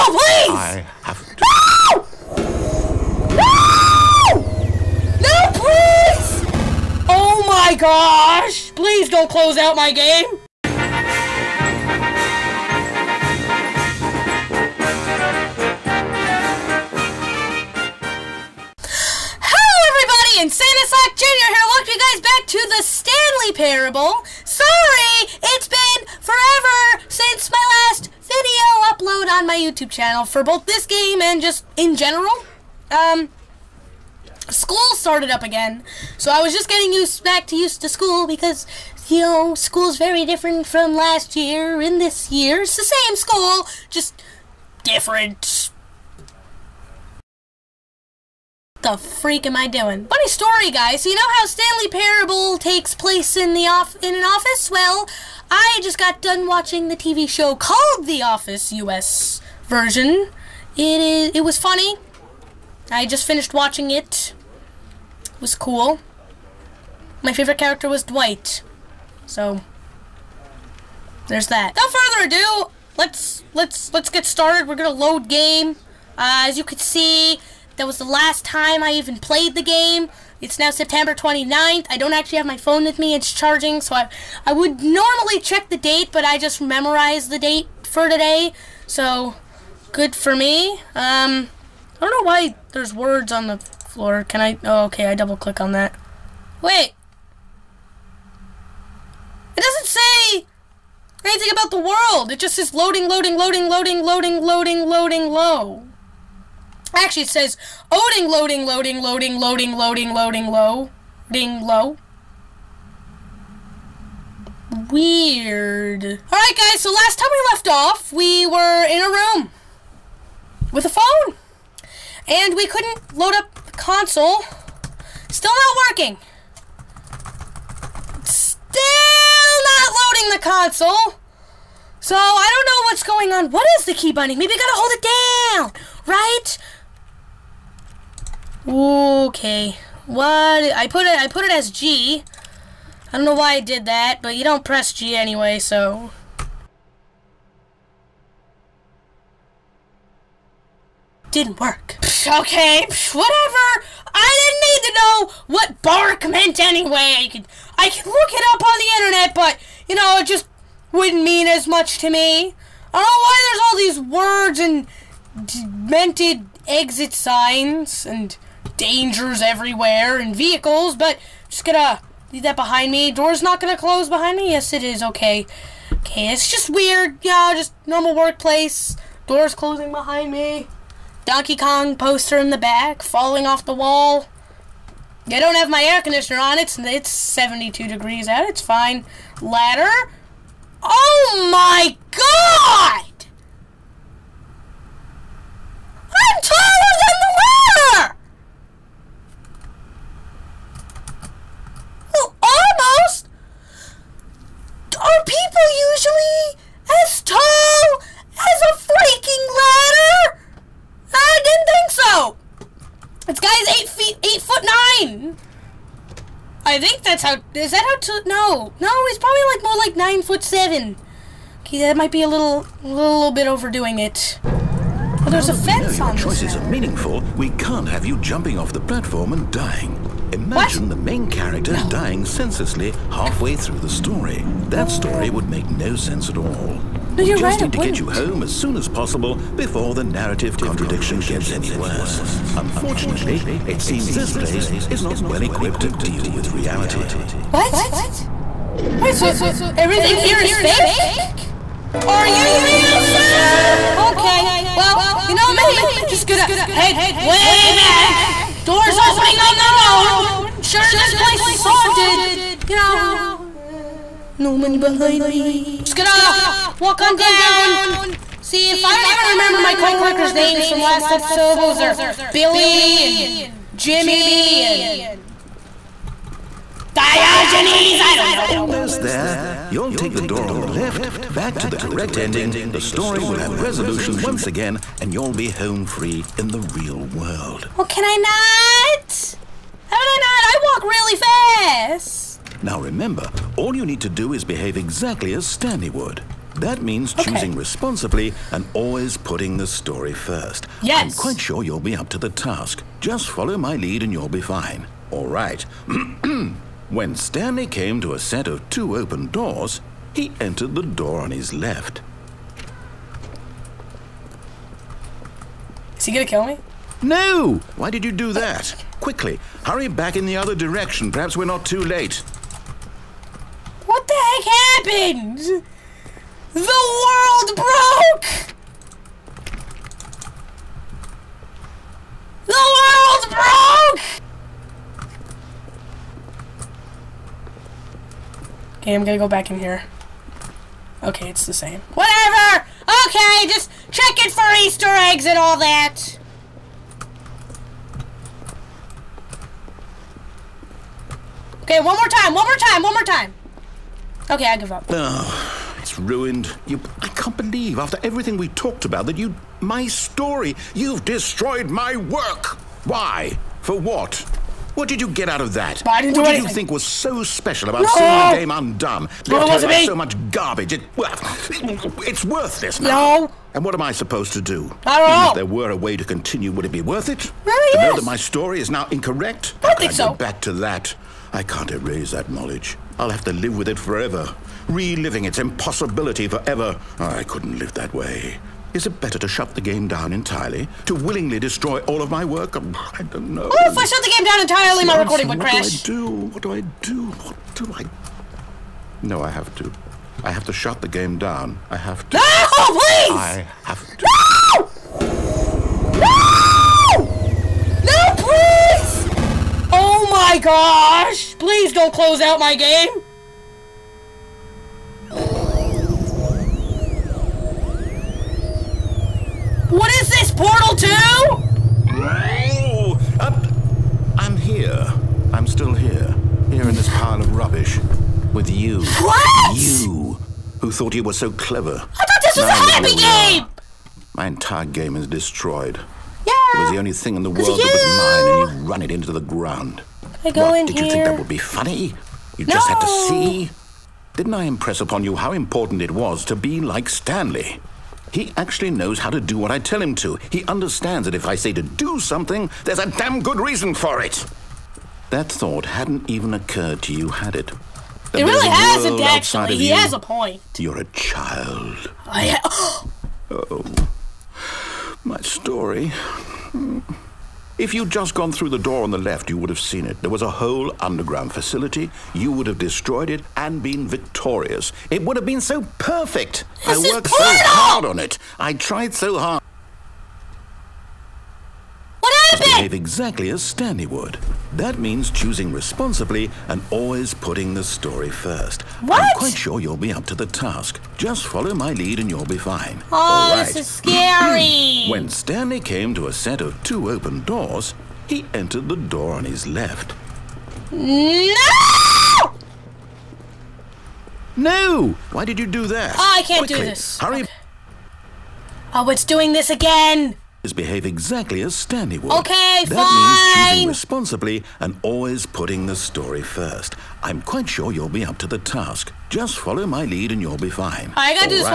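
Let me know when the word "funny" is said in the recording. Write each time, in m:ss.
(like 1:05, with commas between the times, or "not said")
0:50, 1:01, 7:21.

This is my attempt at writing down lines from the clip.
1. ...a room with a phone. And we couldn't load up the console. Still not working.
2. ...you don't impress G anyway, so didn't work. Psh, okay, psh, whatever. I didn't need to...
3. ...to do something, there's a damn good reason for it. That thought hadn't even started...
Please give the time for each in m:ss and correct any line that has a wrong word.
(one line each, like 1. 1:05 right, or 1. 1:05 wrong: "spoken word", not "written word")
1. 1:59 right
2. 2:24 wrong: "press", not "impress"
3. 7:31 wrong: "occurred", not "started".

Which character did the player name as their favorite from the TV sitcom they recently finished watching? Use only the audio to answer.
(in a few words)
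Dwight.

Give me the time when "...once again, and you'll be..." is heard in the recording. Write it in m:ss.
4:44.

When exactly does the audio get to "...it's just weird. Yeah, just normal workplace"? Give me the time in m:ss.
2:56.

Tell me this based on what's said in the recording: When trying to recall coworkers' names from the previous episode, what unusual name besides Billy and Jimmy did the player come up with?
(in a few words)
Diogenes.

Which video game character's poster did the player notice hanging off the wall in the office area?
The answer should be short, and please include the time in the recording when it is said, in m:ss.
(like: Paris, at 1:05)
Donkey Kong, at 3:01.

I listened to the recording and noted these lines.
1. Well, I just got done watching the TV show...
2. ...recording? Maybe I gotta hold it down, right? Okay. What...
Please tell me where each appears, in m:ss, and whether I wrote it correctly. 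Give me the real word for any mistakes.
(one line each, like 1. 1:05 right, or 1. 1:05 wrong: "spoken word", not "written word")
1. 0:54 right
2. 2:14 wrong: "binding", not "recording".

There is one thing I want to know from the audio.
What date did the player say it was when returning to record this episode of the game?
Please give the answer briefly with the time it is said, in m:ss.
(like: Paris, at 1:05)
September 29th, at 1:20.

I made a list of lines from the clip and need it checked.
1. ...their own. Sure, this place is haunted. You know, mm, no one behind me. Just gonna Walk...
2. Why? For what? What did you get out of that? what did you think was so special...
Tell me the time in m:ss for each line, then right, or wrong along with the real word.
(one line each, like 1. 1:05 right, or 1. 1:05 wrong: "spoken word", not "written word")
1. 4:19 right
2. 6:02 right.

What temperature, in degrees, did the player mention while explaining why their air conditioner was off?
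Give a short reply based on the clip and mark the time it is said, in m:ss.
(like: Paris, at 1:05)
72, at 3:07.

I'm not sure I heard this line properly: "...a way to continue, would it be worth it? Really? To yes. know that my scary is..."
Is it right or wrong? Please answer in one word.
wrong.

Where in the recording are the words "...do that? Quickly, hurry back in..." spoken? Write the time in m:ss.
5:18.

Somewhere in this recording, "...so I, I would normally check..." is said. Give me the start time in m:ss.
1:23.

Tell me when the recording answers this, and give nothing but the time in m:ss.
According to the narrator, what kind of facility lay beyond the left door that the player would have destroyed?
7:50.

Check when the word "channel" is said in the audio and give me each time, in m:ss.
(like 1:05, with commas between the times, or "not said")
0:29.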